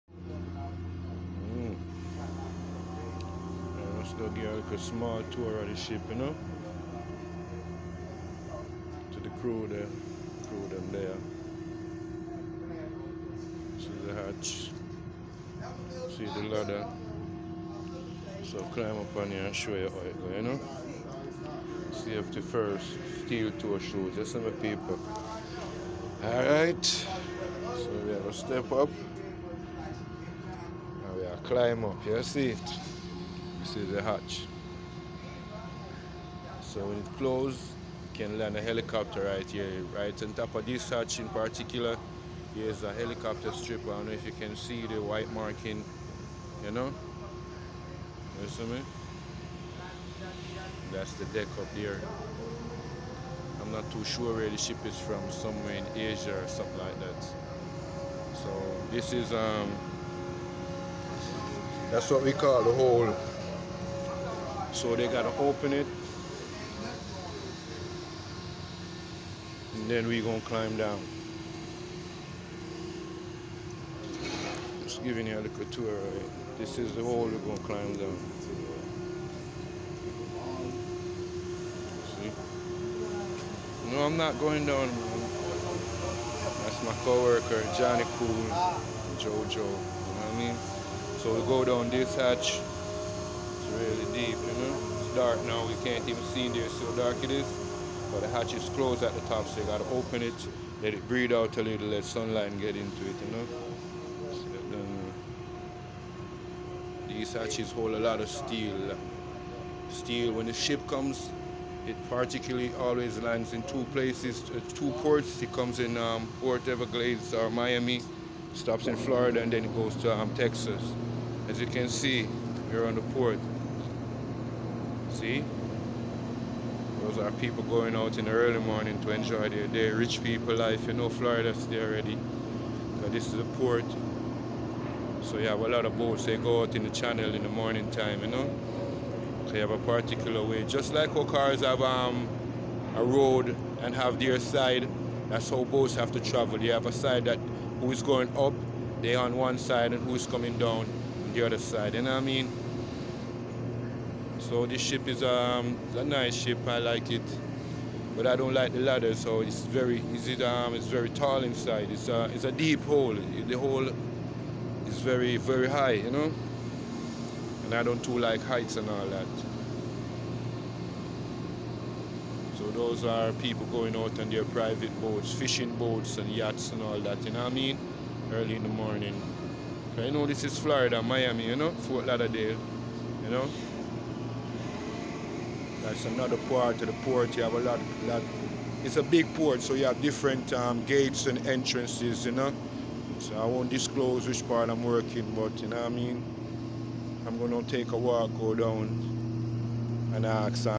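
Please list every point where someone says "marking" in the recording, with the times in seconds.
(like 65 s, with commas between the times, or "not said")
45 s.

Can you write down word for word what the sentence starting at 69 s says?
And then we gonna climb down.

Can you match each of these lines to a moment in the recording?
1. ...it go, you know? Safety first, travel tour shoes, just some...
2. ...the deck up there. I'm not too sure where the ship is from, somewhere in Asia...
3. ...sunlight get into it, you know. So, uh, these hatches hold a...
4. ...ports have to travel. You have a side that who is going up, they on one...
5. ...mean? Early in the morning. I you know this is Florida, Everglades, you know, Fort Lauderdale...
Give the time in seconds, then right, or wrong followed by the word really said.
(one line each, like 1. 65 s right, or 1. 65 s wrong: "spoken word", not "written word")
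1. 20 s wrong: "steel", not "travel"
2. 51 s right
3. 102 s right
4. 145 s wrong: "boats", not "ports"
5. 177 s wrong: "Miami", not "Everglades".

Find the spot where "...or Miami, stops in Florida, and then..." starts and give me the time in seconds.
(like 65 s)
117 s.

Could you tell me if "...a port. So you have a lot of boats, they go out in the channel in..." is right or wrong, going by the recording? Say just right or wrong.
right.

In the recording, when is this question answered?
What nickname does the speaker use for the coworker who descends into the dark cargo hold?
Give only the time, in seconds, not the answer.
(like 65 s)
89 s.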